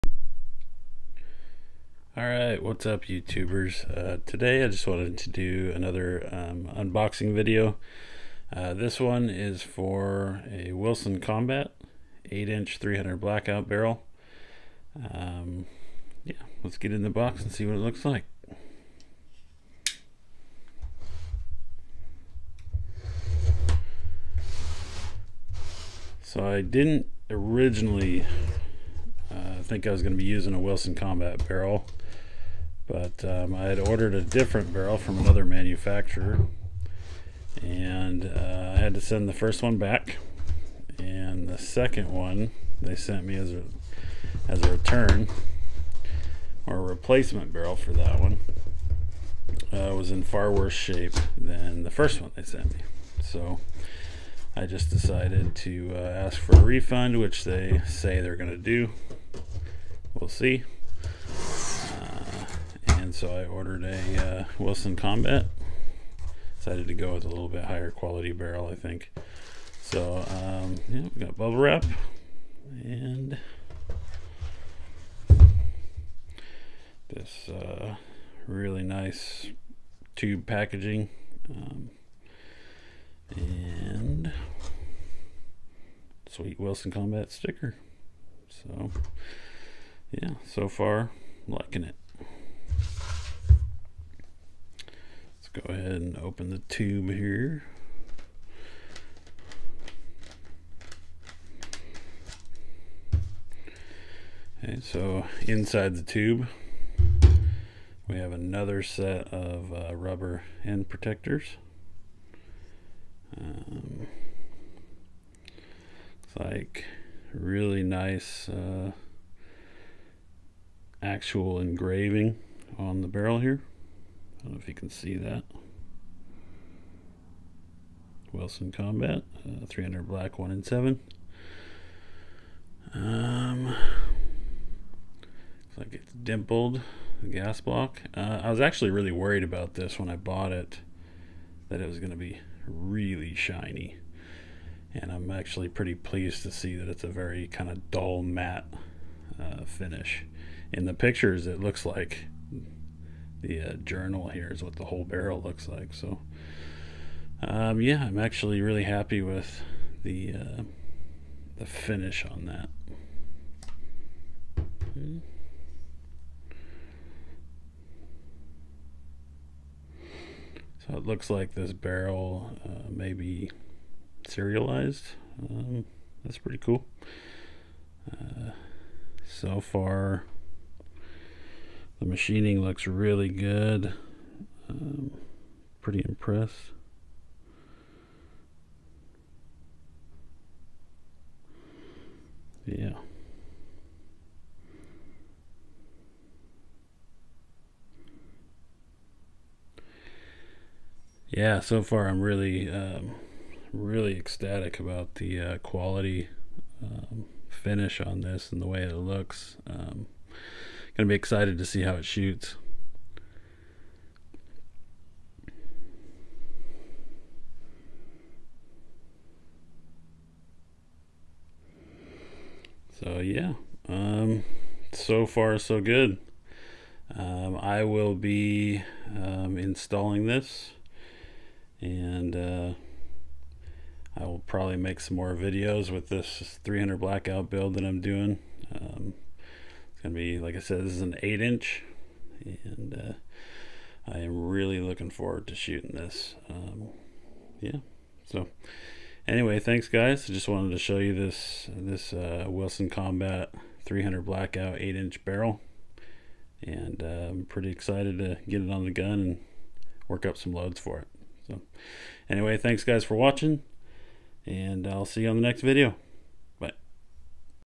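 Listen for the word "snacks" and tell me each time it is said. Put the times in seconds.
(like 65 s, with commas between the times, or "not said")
not said.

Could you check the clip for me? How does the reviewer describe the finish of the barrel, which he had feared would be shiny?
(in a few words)
dull matte.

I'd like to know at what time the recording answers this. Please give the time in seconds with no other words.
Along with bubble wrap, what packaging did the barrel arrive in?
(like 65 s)
80 s.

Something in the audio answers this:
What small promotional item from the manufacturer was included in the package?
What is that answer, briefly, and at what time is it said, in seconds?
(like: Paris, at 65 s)
Wilson Combat sticker, at 86 s.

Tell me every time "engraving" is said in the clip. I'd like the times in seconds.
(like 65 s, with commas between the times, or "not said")
121 s.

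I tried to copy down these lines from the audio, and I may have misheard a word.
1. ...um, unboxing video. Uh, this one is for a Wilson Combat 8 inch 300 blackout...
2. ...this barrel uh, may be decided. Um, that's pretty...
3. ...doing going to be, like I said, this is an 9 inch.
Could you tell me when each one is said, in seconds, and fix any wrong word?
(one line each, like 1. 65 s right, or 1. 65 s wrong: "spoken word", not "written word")
1. 6 s right
2. 171 s wrong: "serialized", not "decided"
3. 238 s wrong: "8", not "9".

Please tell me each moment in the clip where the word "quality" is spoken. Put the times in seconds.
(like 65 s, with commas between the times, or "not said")
67 s, 205 s.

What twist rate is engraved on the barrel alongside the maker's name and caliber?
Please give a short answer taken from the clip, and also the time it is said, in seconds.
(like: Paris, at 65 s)
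1 in 7, at 130 s.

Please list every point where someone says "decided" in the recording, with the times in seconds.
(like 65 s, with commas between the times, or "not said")
54 s, 66 s.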